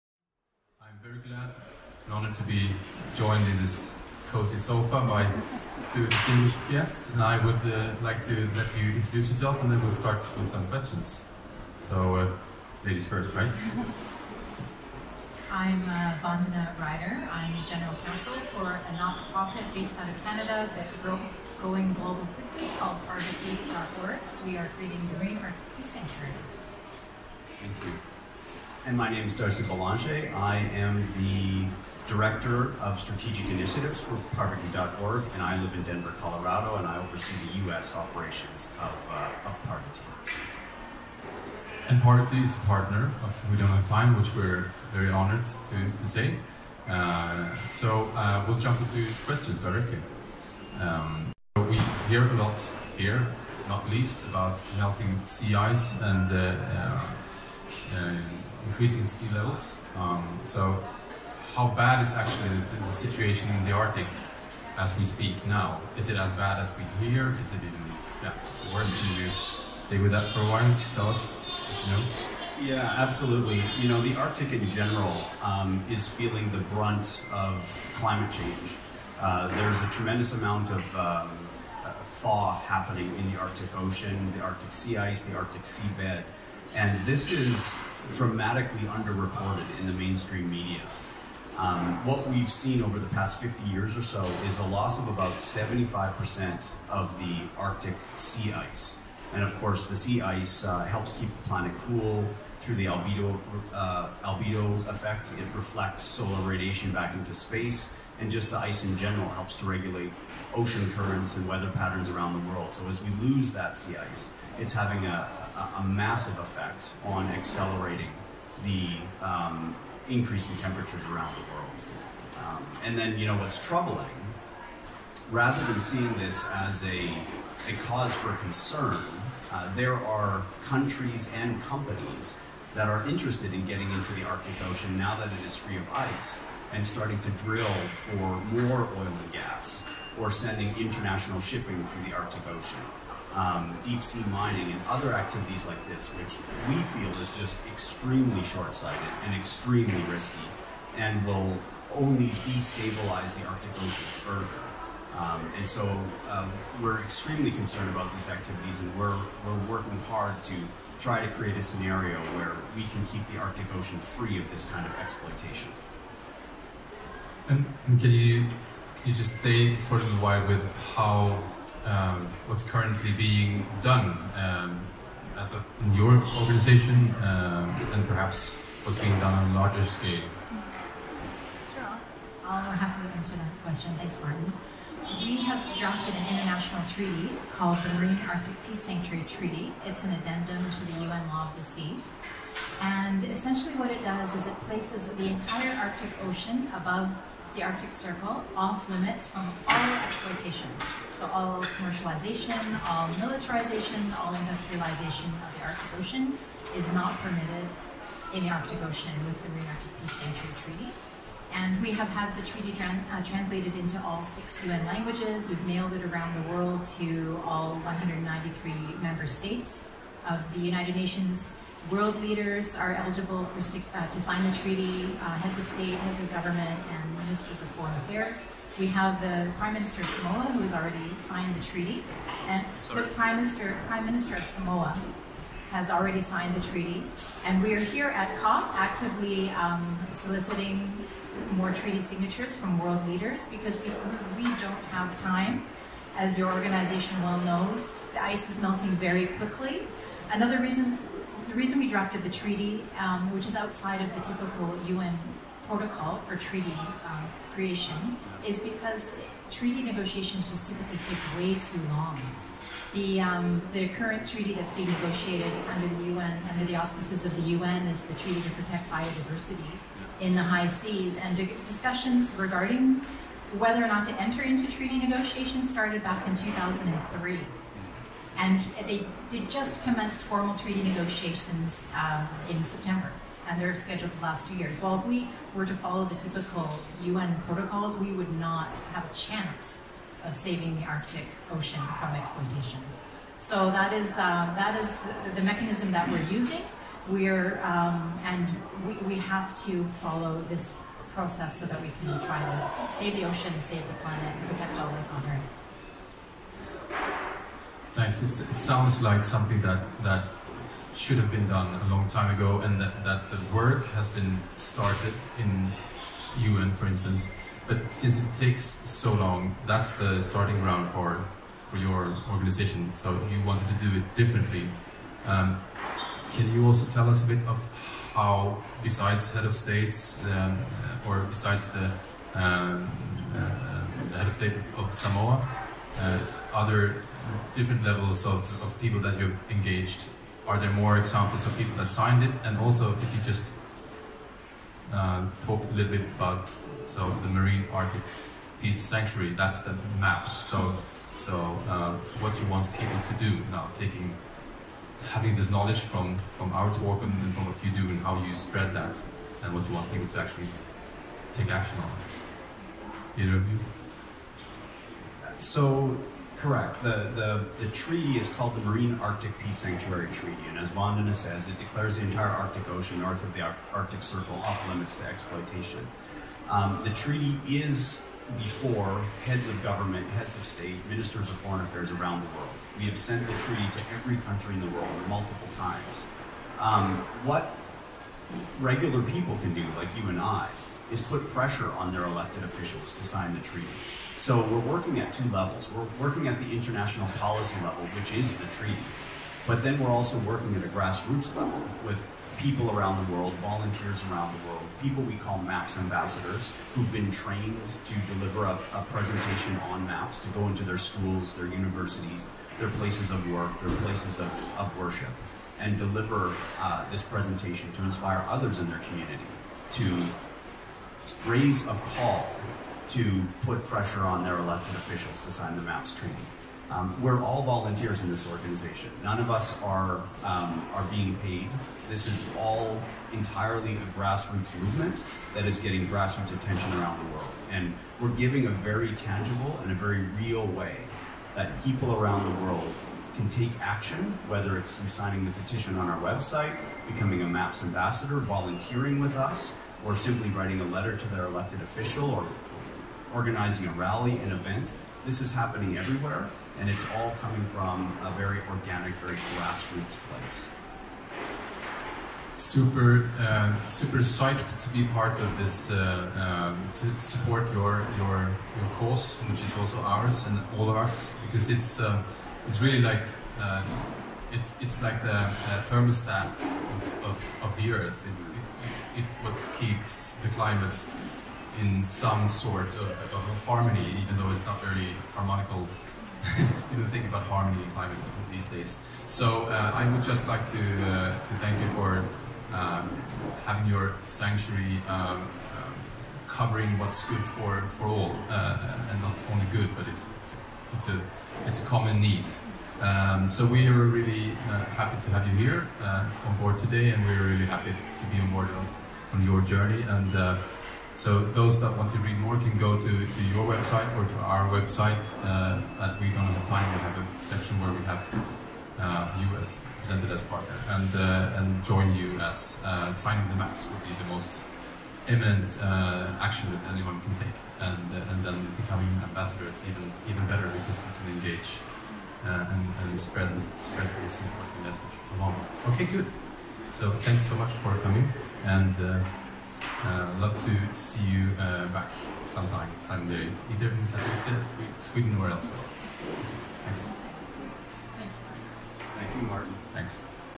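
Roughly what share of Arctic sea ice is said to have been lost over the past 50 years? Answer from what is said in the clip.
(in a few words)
75%.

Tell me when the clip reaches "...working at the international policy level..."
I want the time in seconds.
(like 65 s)
396 s.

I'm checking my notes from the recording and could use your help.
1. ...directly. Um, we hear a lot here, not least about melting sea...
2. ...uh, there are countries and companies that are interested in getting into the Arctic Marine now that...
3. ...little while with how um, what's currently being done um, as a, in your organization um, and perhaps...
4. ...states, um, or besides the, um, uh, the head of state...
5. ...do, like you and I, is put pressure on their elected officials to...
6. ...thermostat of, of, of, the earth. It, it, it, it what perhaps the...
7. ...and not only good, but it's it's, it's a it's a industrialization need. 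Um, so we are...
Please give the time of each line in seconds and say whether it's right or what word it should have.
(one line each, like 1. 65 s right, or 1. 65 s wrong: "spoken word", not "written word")
1. 49 s right
2. 129 s wrong: "Ocean", not "Marine"
3. 169 s right
4. 329 s right
5. 389 s right
6. 475 s wrong: "keeps", not "perhaps"
7. 498 s wrong: "common", not "industrialization".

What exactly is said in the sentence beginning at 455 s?
This is happening everywhere, and it's all coming from a very organic, very grassroots place.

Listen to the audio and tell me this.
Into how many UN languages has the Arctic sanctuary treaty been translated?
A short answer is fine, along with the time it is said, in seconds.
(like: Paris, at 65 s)
6, at 214 s.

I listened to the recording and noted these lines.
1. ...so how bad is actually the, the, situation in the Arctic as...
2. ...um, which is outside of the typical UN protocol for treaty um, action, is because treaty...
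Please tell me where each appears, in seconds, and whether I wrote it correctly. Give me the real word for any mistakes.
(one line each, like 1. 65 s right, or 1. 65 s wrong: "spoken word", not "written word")
1. 60 s right
2. 252 s wrong: "creation", not "action".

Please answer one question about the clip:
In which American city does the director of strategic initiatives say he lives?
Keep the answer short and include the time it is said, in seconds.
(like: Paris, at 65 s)
Denver, at 35 s.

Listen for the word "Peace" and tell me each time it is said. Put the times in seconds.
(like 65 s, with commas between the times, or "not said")
25 s, 188 s, 210 s, 348 s, 369 s.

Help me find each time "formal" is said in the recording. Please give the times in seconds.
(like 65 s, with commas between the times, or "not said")
280 s.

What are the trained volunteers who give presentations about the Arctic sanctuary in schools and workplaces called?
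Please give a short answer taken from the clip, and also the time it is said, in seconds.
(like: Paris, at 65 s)
MAPS ambassadors, at 405 s.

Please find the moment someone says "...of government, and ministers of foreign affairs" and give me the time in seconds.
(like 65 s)
226 s.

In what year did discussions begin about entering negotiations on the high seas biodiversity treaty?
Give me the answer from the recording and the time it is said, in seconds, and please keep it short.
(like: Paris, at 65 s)
2003, at 276 s.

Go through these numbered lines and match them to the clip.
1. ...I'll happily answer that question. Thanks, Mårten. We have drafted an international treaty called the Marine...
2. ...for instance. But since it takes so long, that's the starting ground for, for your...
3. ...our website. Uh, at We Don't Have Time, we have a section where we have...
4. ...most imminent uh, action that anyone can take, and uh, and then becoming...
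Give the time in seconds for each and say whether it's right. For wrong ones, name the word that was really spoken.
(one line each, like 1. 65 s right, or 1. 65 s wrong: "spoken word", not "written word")
1. 182 s right
2. 316 s right
3. 514 s right
4. 524 s right.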